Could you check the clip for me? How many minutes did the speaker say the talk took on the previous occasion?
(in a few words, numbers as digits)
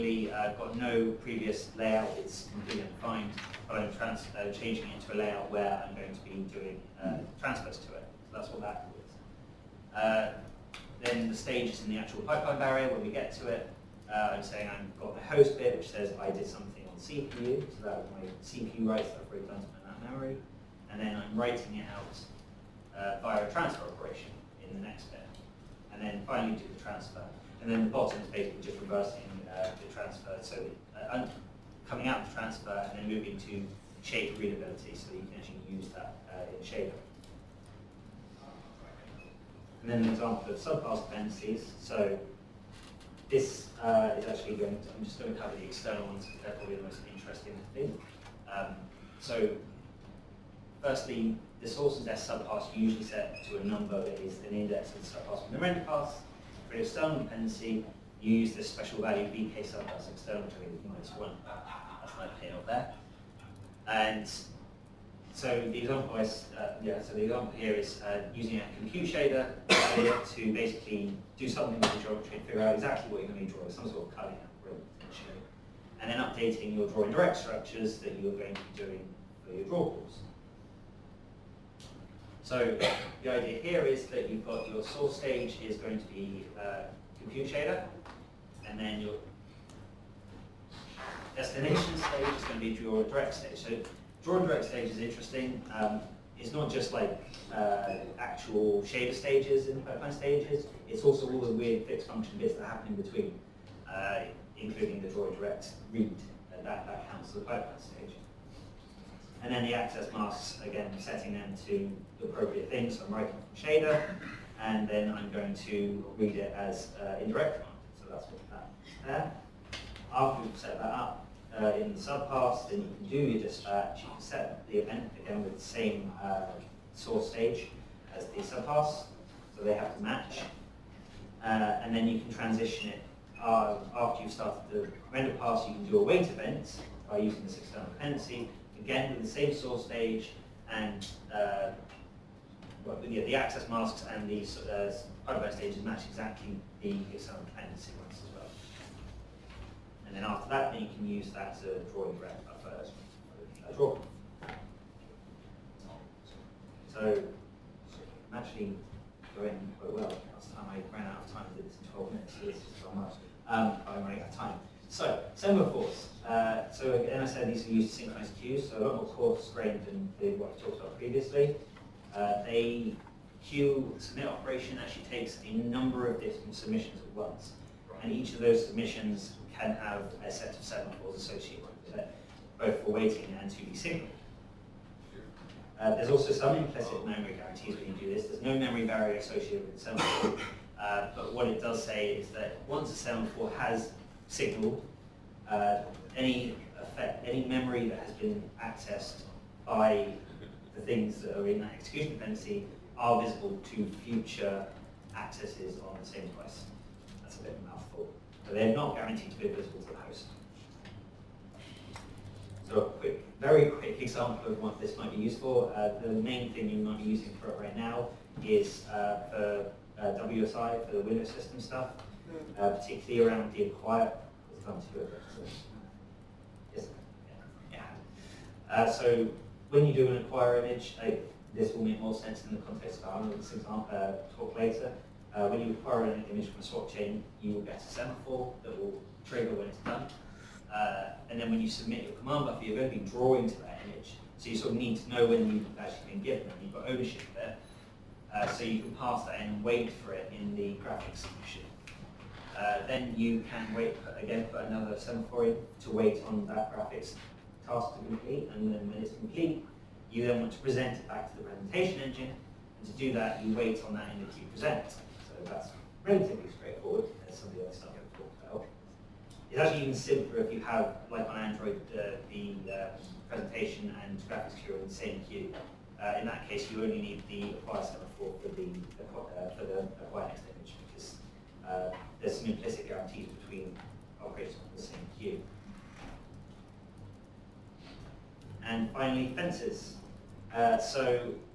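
12.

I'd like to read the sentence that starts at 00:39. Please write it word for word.
And then an example of subpass dependencies.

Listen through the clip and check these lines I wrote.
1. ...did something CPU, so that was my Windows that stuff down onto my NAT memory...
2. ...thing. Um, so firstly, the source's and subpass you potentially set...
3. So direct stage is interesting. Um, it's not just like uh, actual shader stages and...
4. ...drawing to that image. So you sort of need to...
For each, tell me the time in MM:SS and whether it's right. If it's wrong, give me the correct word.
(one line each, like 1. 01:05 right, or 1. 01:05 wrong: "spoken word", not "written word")
1. 00:16 wrong: "CPU", not "Windows"
2. 00:47 wrong: "usually", not "potentially"
3. 01:33 right
4. 04:03 right.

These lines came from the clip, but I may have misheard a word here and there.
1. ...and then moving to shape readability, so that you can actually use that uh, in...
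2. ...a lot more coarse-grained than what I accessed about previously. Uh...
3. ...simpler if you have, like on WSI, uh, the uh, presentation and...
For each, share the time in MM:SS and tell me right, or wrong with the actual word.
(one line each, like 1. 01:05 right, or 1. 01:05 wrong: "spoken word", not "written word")
1. 00:32 right
2. 02:48 wrong: "talked", not "accessed"
3. 04:29 wrong: "Android", not "WSI".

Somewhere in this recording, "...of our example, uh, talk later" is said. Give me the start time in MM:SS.
03:53.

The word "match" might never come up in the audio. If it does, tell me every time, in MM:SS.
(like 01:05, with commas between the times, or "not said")
02:10, 02:25.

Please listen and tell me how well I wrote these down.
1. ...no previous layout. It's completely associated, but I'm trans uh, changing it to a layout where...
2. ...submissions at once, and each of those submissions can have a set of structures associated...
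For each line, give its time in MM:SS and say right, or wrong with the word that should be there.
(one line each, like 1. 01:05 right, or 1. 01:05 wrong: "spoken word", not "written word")
1. 00:00 wrong: "undefined", not "associated"
2. 02:56 wrong: "semaphores", not "structures".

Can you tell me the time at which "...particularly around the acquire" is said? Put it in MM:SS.
03:42.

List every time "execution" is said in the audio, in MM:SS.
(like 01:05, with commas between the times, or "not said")
03:21.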